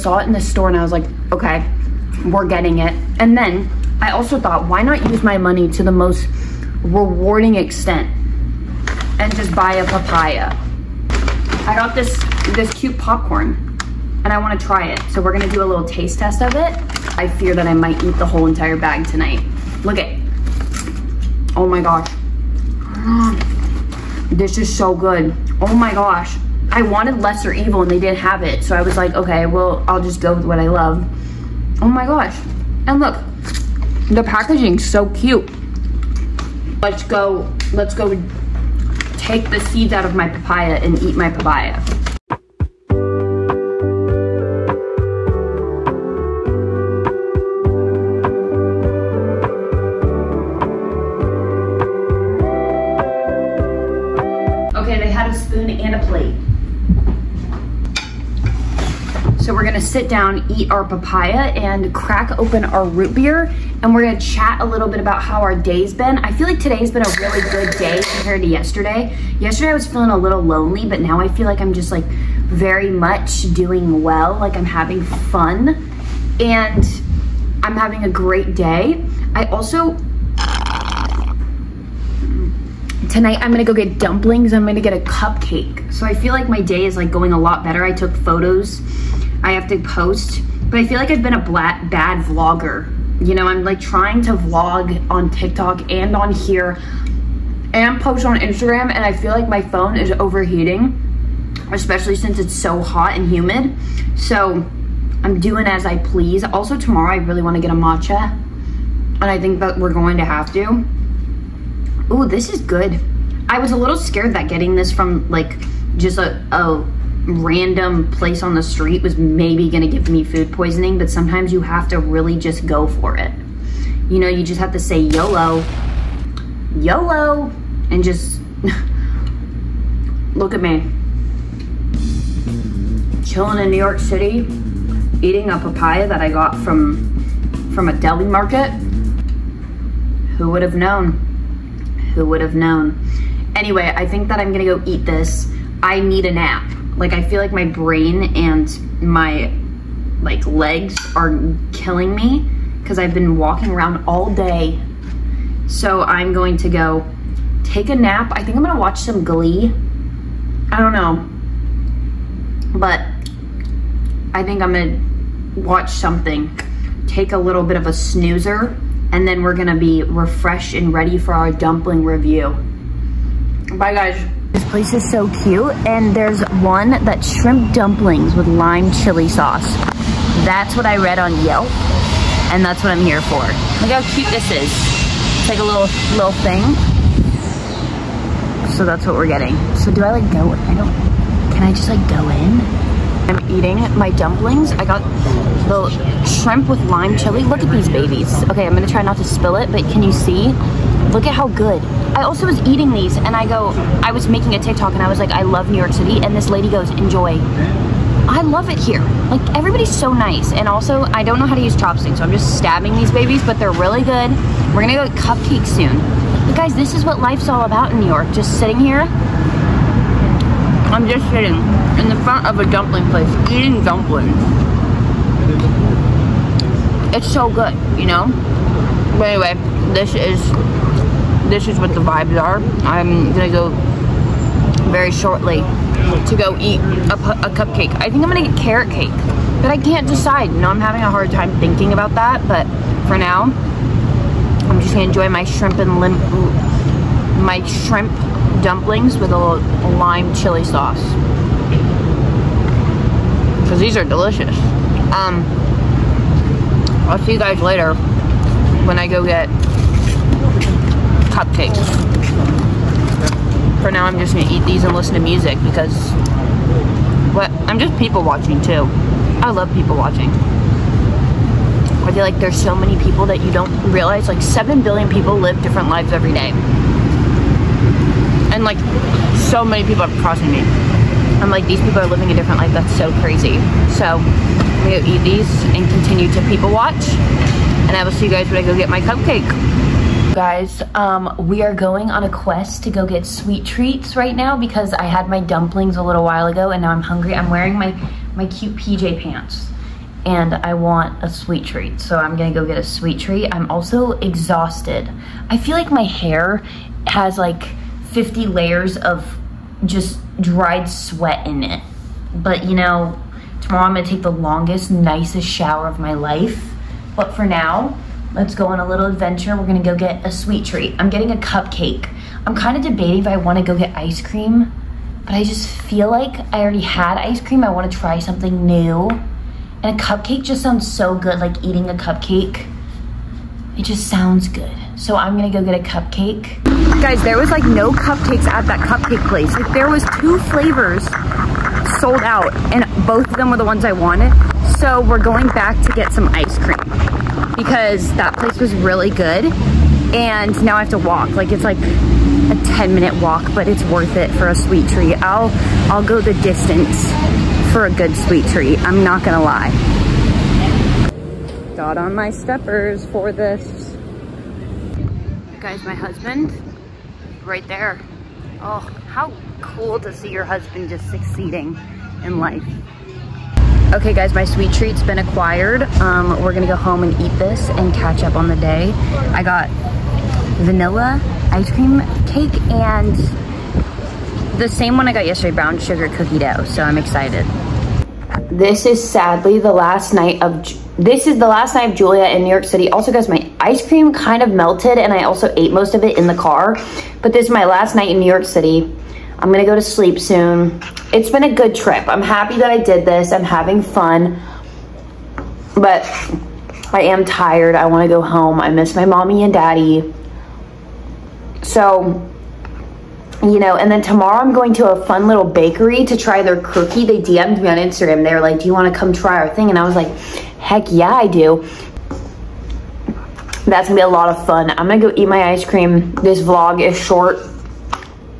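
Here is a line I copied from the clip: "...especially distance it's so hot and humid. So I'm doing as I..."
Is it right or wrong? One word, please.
wrong.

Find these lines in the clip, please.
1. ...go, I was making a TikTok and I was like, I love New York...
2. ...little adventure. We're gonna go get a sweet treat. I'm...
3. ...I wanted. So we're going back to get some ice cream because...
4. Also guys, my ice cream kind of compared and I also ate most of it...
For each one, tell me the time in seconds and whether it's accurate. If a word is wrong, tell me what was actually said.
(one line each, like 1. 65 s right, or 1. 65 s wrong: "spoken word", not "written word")
1. 203 s right
2. 318 s right
3. 343 s right
4. 392 s wrong: "melted", not "compared".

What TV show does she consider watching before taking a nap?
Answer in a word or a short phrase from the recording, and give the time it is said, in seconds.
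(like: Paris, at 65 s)
Glee, at 159 s.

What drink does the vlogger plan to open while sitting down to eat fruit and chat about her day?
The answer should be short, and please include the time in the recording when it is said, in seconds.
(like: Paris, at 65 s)
Root beer, at 62 s.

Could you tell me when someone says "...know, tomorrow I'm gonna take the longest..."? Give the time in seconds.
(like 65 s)
312 s.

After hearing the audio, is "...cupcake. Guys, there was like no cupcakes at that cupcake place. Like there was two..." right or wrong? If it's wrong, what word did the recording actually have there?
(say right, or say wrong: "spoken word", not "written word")
right.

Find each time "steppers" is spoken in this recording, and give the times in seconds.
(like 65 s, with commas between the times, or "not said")
362 s.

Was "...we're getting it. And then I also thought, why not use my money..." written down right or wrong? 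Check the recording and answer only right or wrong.
right.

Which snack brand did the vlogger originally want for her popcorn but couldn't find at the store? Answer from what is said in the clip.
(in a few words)
Lesser Evil.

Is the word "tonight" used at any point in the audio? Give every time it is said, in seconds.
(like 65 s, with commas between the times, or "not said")
19 s, 83 s.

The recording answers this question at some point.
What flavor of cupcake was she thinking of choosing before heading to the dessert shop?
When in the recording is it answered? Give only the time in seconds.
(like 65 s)
238 s.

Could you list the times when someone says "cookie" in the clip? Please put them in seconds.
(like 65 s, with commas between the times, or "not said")
386 s, 416 s.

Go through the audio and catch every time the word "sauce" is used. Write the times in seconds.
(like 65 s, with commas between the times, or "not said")
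179 s, 250 s.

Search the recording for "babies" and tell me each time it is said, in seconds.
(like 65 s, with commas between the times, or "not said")
197 s, 213 s.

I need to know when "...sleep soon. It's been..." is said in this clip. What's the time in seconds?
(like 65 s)
399 s.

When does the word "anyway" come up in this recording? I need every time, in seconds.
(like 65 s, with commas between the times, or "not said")
143 s, 229 s.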